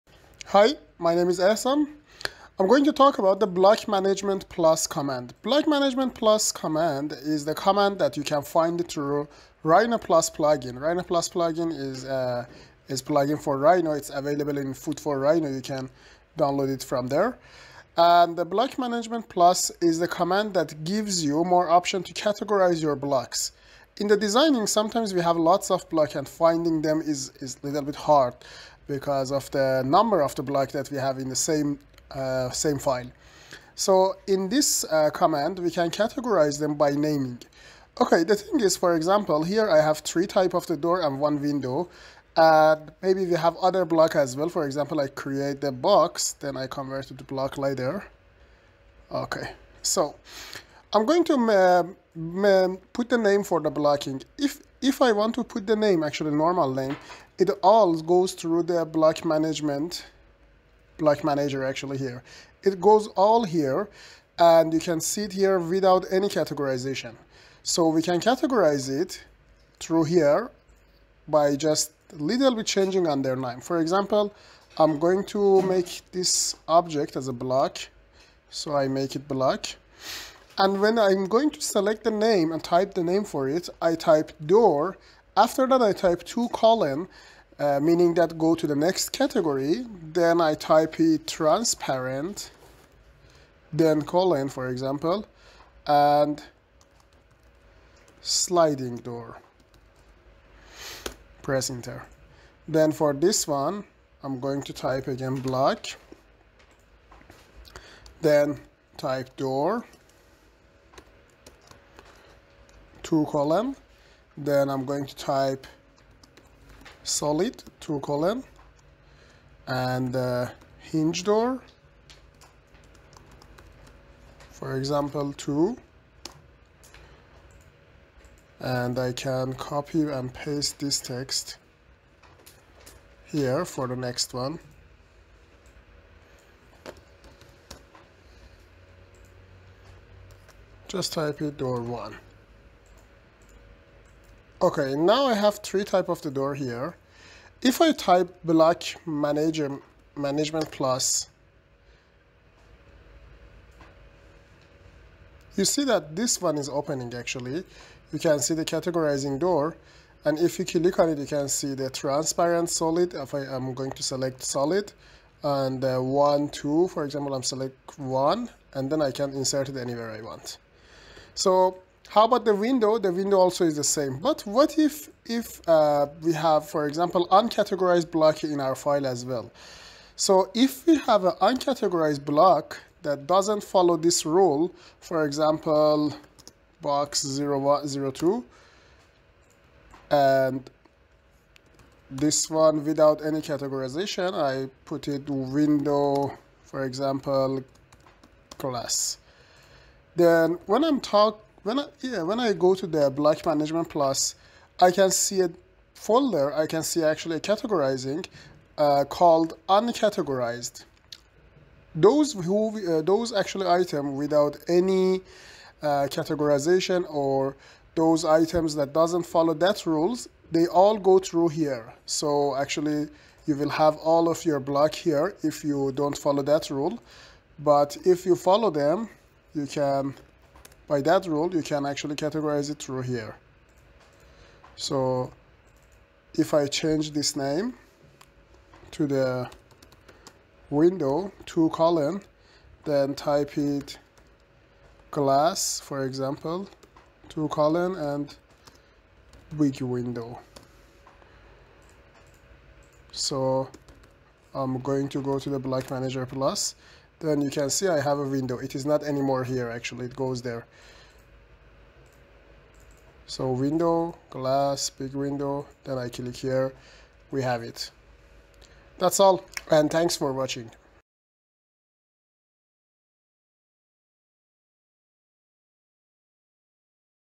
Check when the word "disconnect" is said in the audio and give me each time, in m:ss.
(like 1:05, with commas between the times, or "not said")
not said.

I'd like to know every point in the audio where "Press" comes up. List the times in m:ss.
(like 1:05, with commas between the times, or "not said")
1:41.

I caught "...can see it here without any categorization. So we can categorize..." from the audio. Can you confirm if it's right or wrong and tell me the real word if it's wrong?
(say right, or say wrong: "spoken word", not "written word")
right.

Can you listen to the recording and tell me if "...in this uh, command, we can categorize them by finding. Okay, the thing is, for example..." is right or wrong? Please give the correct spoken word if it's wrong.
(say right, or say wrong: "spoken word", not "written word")
wrong: "naming", not "finding".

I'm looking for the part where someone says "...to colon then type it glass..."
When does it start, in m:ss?
4:01.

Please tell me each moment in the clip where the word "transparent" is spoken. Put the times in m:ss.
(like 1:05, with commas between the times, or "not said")
1:31, 2:41.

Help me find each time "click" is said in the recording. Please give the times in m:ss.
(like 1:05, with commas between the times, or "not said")
2:40, 4:26.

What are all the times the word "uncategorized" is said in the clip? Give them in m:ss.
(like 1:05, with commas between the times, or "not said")
2:57, 3:01, 3:29.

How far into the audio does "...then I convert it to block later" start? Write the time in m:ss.
0:46.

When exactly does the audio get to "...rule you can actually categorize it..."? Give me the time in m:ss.
3:51.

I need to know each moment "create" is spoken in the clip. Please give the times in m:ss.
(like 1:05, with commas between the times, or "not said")
0:45.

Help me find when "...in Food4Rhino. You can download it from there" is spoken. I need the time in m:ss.
0:14.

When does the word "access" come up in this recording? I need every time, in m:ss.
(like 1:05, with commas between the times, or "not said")
not said.